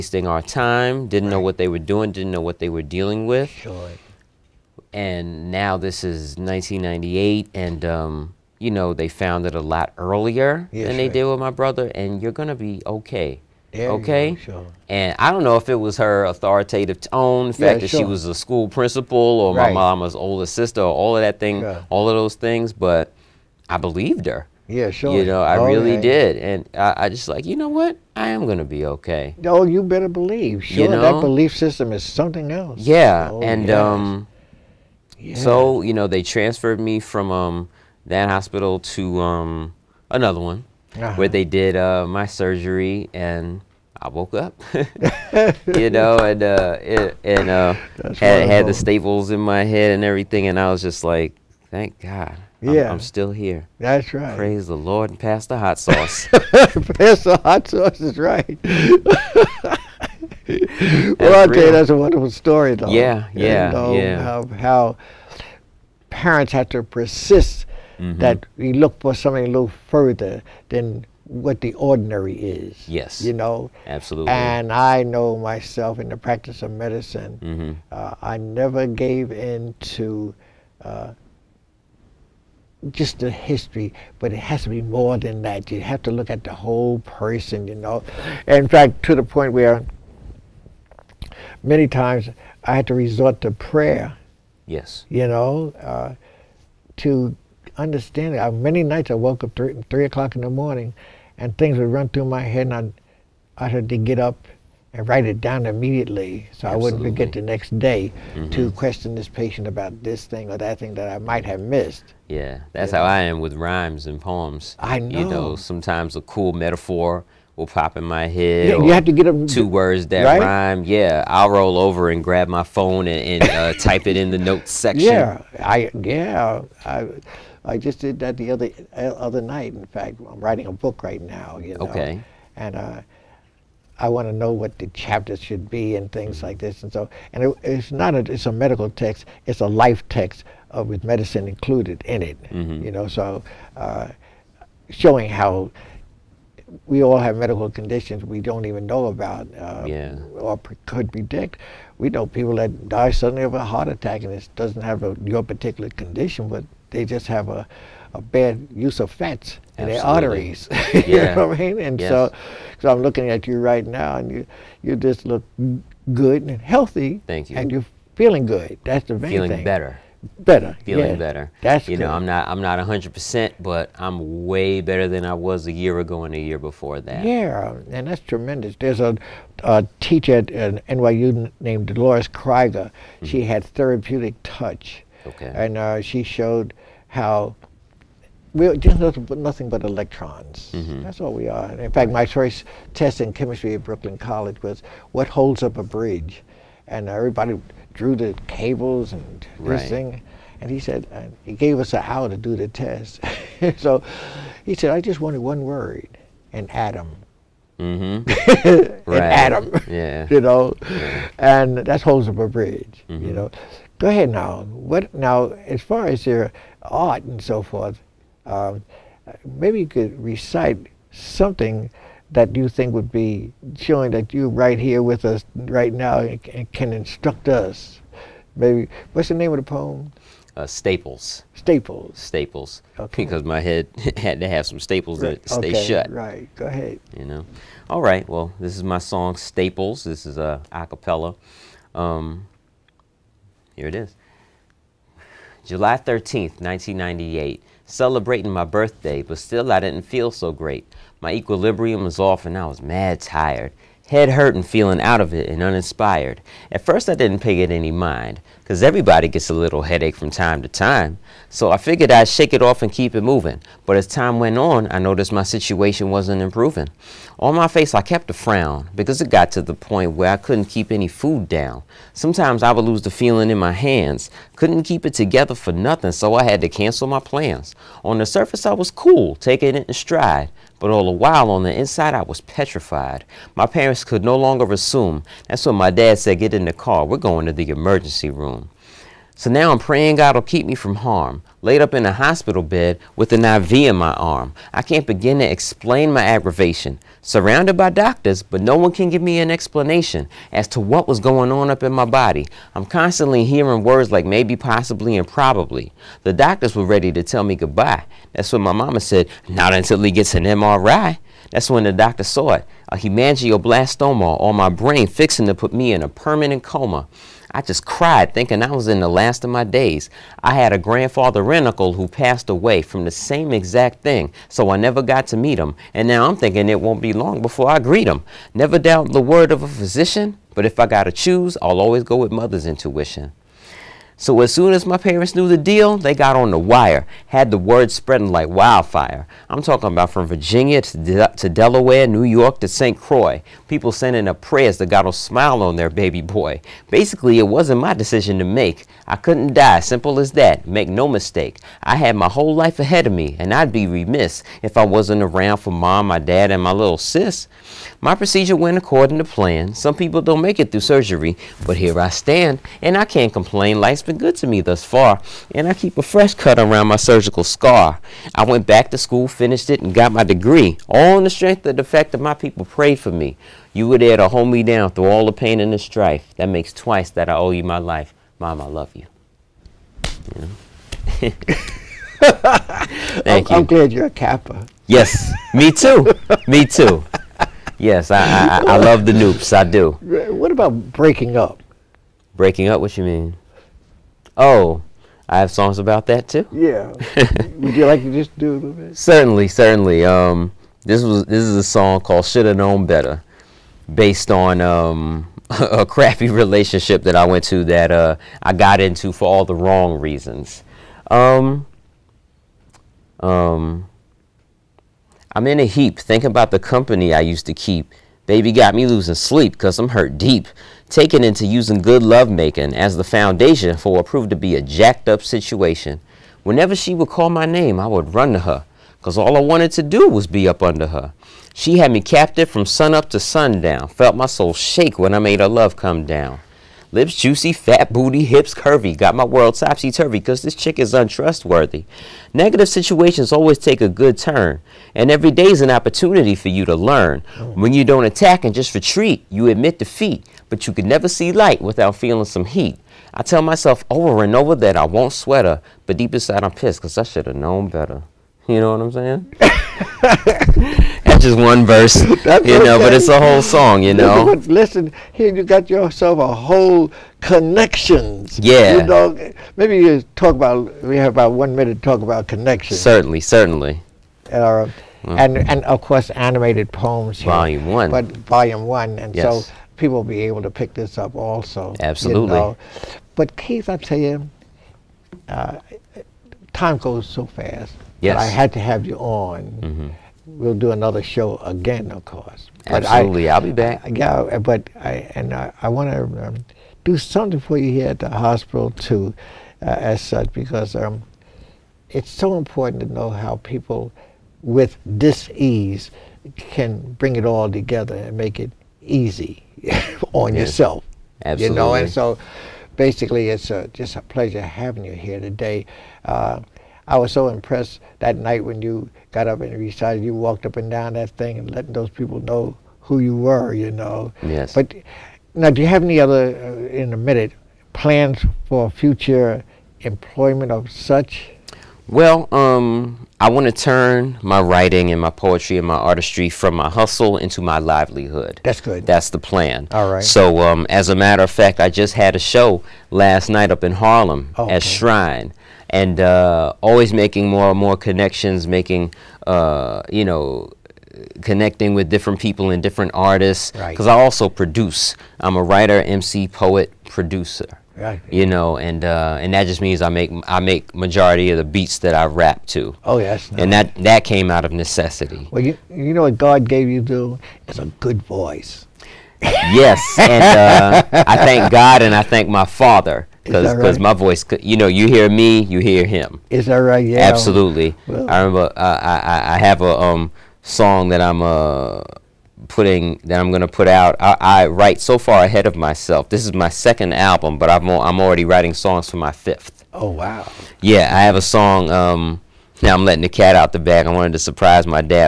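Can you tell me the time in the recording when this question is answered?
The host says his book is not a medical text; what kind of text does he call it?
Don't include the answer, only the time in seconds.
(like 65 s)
139 s.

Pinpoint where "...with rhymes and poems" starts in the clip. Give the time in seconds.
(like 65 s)
113 s.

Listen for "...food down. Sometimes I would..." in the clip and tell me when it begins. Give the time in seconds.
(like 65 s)
271 s.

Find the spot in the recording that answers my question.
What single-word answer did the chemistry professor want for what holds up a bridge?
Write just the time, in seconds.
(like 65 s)
206 s.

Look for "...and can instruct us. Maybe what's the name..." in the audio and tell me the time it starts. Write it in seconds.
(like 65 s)
226 s.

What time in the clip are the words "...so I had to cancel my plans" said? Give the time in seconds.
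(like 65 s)
276 s.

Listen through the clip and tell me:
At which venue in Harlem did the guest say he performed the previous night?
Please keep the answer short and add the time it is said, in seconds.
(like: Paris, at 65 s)
Shrine, at 544 s.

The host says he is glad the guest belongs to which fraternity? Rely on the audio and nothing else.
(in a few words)
Kappa.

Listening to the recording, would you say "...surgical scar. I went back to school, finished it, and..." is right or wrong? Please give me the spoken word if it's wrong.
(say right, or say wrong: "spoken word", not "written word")
right.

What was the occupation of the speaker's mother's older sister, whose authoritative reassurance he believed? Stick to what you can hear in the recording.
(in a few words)
School principal.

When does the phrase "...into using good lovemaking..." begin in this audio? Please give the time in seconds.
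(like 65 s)
421 s.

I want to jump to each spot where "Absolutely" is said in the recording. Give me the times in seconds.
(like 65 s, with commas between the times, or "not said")
73 s, 106 s, 481 s, 492 s, 511 s, 577 s.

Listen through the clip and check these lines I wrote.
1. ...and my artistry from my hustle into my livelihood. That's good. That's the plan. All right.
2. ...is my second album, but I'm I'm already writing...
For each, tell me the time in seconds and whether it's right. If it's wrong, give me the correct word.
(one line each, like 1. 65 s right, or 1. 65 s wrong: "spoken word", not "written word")
1. 535 s right
2. 586 s right.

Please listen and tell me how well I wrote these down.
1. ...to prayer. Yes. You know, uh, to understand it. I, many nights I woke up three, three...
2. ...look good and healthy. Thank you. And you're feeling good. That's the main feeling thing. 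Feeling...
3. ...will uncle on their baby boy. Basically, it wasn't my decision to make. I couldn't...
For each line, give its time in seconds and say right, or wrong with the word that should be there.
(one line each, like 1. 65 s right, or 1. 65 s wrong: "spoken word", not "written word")
1. 93 s right
2. 165 s right
3. 345 s wrong: "smile", not "uncle".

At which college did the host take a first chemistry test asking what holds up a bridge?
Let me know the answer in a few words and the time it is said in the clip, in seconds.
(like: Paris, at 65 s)
Brooklyn College, at 193 s.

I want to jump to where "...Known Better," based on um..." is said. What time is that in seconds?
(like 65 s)
402 s.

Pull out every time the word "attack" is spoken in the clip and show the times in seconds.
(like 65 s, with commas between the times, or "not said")
153 s, 448 s.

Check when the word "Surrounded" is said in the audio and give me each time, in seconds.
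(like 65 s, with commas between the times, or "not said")
297 s.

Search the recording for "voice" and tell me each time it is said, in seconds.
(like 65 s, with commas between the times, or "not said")
568 s, 573 s.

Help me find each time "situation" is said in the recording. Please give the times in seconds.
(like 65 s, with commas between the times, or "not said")
265 s, 425 s, 442 s.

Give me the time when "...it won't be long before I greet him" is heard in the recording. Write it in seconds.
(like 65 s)
326 s.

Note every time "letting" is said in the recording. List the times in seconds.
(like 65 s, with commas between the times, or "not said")
521 s, 592 s.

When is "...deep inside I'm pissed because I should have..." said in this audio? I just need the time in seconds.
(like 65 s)
455 s.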